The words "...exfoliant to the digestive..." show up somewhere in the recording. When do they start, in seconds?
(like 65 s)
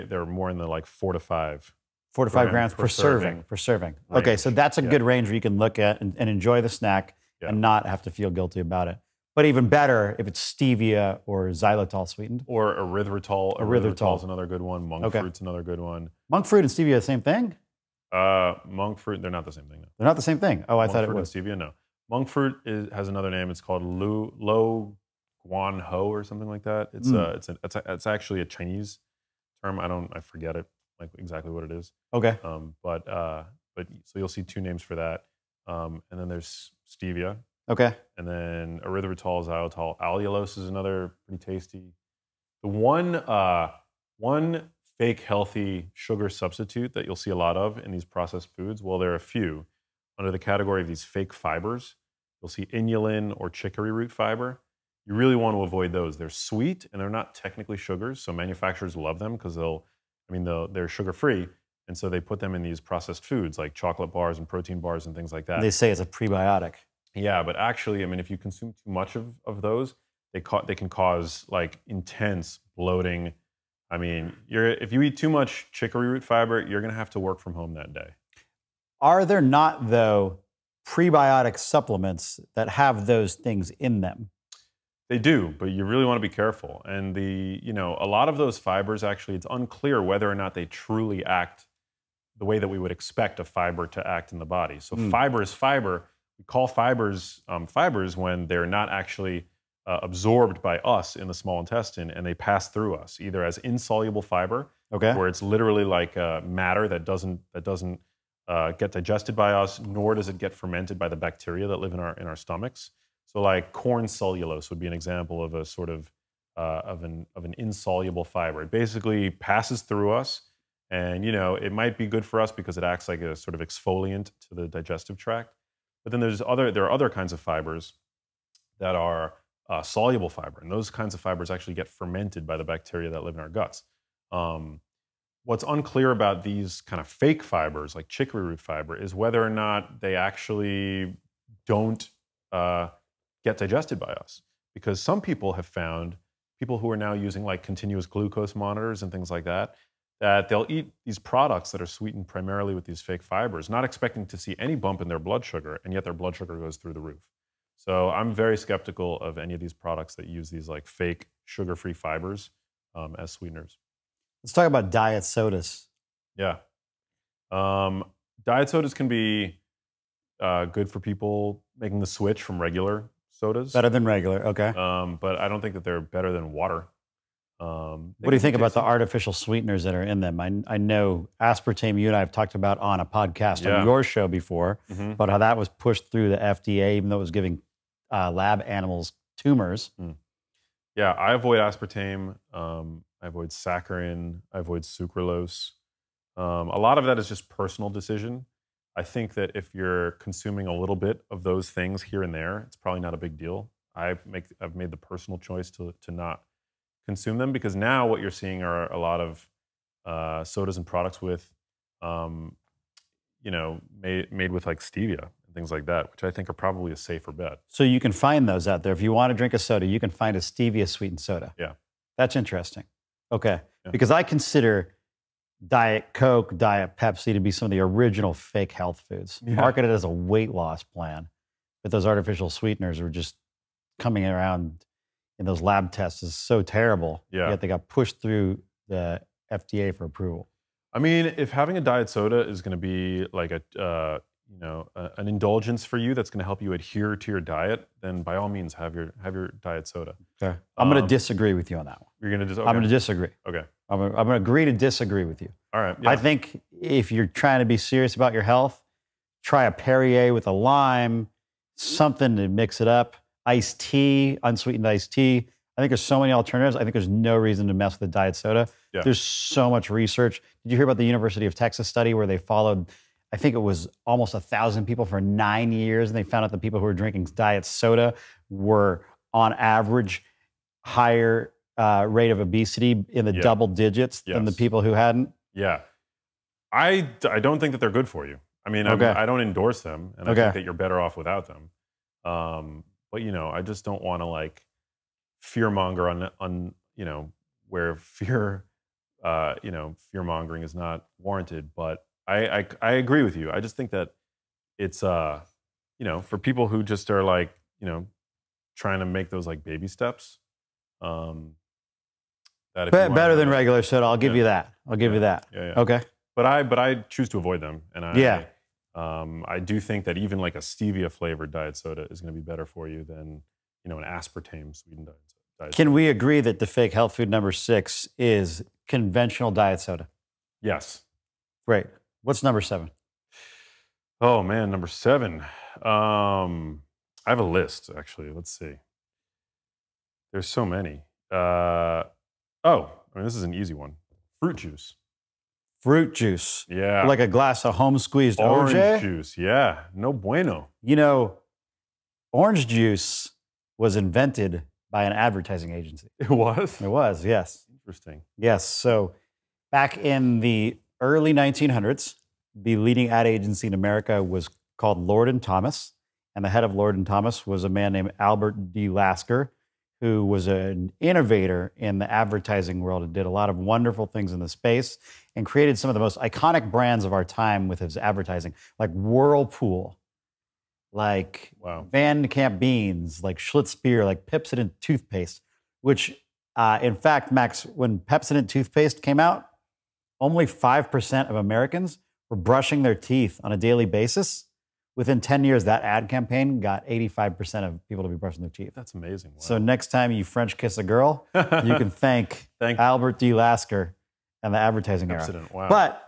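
123 s.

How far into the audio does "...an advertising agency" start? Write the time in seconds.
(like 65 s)
355 s.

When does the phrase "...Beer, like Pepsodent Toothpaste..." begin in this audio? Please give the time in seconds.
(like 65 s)
383 s.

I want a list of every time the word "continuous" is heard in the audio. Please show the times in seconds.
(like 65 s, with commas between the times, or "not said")
147 s.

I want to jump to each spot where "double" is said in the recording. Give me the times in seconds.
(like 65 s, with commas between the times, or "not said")
283 s.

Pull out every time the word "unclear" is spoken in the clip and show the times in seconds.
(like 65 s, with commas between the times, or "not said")
89 s, 135 s.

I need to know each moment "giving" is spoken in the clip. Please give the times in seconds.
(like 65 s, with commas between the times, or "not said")
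187 s.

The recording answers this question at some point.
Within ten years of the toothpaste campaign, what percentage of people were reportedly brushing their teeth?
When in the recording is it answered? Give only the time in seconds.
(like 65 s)
396 s.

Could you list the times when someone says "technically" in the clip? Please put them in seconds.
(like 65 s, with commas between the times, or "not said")
57 s.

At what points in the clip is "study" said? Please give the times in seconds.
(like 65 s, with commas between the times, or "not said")
271 s.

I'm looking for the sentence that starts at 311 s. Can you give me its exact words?
Um, that Be- better than regular soda, I'll give yeah.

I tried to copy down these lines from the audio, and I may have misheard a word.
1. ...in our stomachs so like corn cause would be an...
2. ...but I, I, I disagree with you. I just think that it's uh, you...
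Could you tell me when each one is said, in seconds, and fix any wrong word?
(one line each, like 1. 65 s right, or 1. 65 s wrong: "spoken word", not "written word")
1. 112 s wrong: "cellulose", not "cause"
2. 301 s wrong: "agree", not "disagree".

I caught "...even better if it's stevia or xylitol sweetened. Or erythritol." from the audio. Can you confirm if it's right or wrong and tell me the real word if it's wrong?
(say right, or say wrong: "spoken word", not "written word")
right.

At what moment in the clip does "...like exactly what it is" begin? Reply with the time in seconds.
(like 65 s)
30 s.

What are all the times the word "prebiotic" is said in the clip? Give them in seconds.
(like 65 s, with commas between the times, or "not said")
66 s, 80 s.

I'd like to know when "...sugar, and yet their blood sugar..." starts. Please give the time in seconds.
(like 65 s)
155 s.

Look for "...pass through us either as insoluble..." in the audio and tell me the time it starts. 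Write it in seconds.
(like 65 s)
102 s.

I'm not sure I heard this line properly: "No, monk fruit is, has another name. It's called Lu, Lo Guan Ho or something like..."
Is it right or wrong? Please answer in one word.
right.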